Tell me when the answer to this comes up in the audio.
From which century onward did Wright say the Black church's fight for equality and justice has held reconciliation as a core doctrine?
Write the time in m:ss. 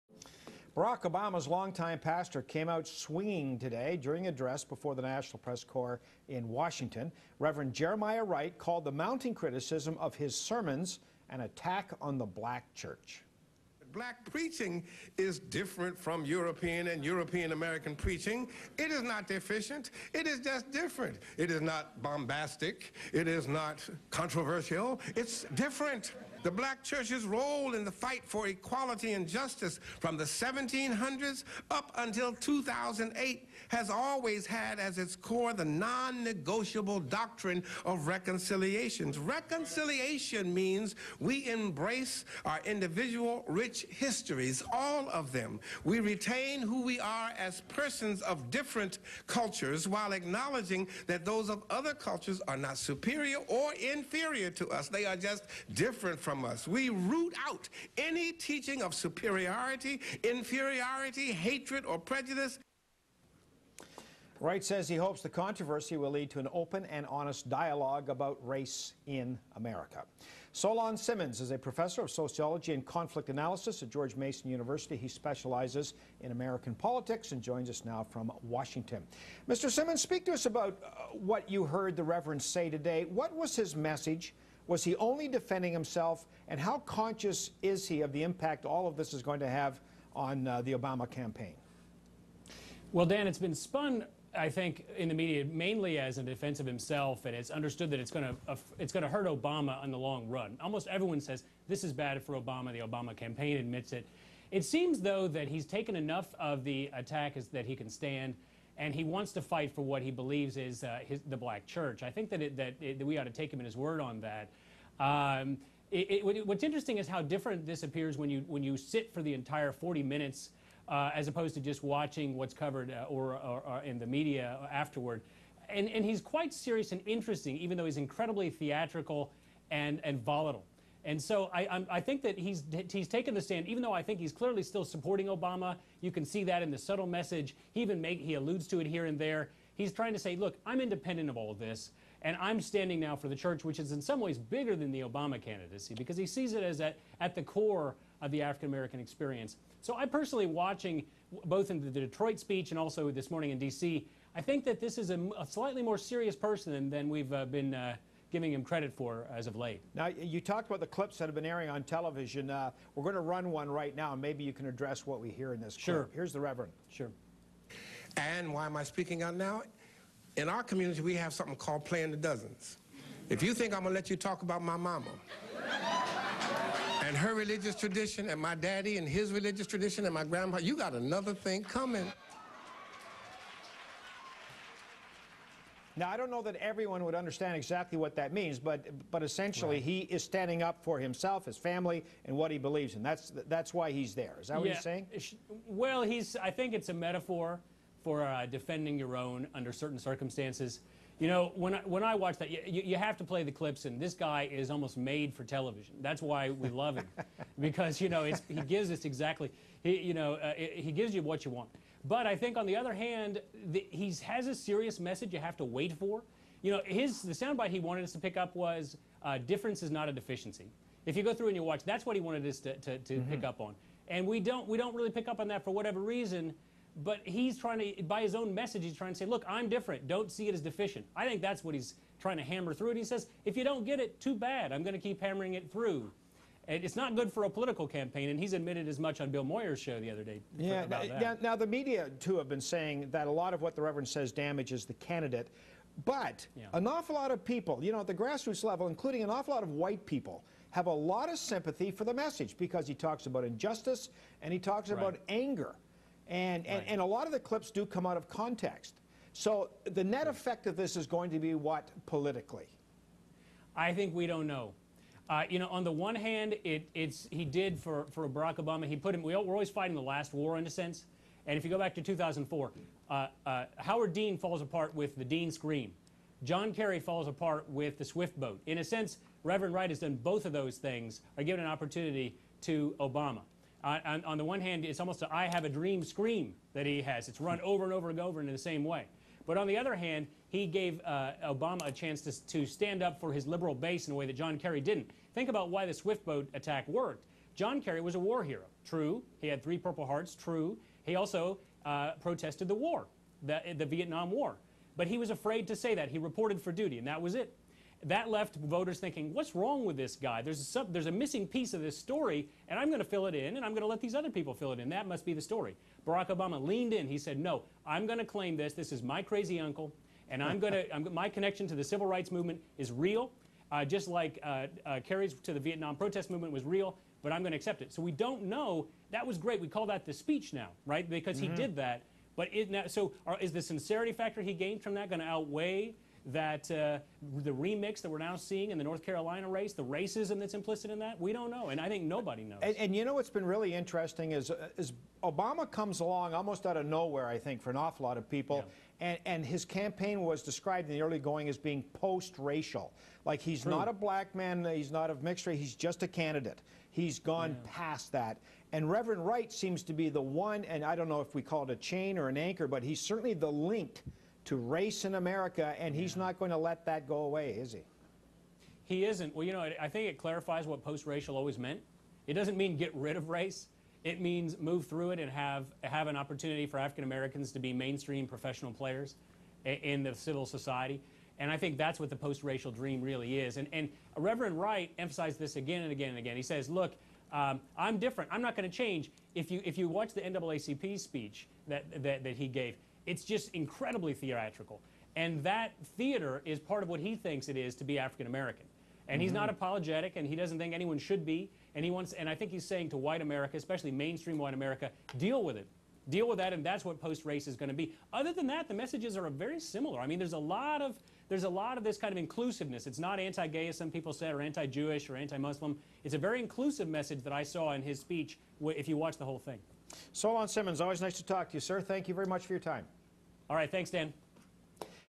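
0:30.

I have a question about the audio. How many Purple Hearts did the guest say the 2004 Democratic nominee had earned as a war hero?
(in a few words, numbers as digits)
3.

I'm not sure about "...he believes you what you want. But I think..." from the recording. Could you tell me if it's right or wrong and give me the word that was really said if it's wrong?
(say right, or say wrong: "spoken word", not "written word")
wrong: "gives", not "believes".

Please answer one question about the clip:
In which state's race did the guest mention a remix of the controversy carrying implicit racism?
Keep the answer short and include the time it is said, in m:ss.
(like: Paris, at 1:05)
North Carolina, at 5:38.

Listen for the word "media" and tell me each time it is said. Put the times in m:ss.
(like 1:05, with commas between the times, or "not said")
1:35, 2:04, 4:01.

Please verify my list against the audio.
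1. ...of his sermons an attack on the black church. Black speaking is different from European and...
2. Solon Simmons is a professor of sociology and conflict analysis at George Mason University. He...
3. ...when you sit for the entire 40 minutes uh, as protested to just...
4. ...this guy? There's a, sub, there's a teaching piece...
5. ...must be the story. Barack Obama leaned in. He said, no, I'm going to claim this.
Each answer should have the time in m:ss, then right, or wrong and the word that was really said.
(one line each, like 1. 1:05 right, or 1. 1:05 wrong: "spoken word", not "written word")
1. 0:09 wrong: "preaching", not "speaking"
2. 1:10 right
3. 1:58 wrong: "opposed", not "protested"
4. 5:09 wrong: "missing", not "teaching"
5. 5:15 right.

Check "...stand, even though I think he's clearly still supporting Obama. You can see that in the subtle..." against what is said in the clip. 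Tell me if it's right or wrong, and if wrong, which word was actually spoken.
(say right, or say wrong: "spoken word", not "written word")
right.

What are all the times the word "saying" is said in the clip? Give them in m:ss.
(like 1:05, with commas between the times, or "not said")
3:14, 4:02, 6:42.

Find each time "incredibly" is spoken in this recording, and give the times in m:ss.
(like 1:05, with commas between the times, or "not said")
2:07, 6:33.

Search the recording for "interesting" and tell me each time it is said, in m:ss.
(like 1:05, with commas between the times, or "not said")
1:56, 2:07, 5:43.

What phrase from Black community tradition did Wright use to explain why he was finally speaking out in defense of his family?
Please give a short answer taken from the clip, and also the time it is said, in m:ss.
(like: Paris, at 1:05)
playing the dozens, at 2:51.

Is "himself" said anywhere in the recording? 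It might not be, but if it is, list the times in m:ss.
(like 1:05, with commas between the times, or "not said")
1:25, 1:36, 3:10.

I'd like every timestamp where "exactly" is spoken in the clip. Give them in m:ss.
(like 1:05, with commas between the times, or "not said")
3:07, 3:29.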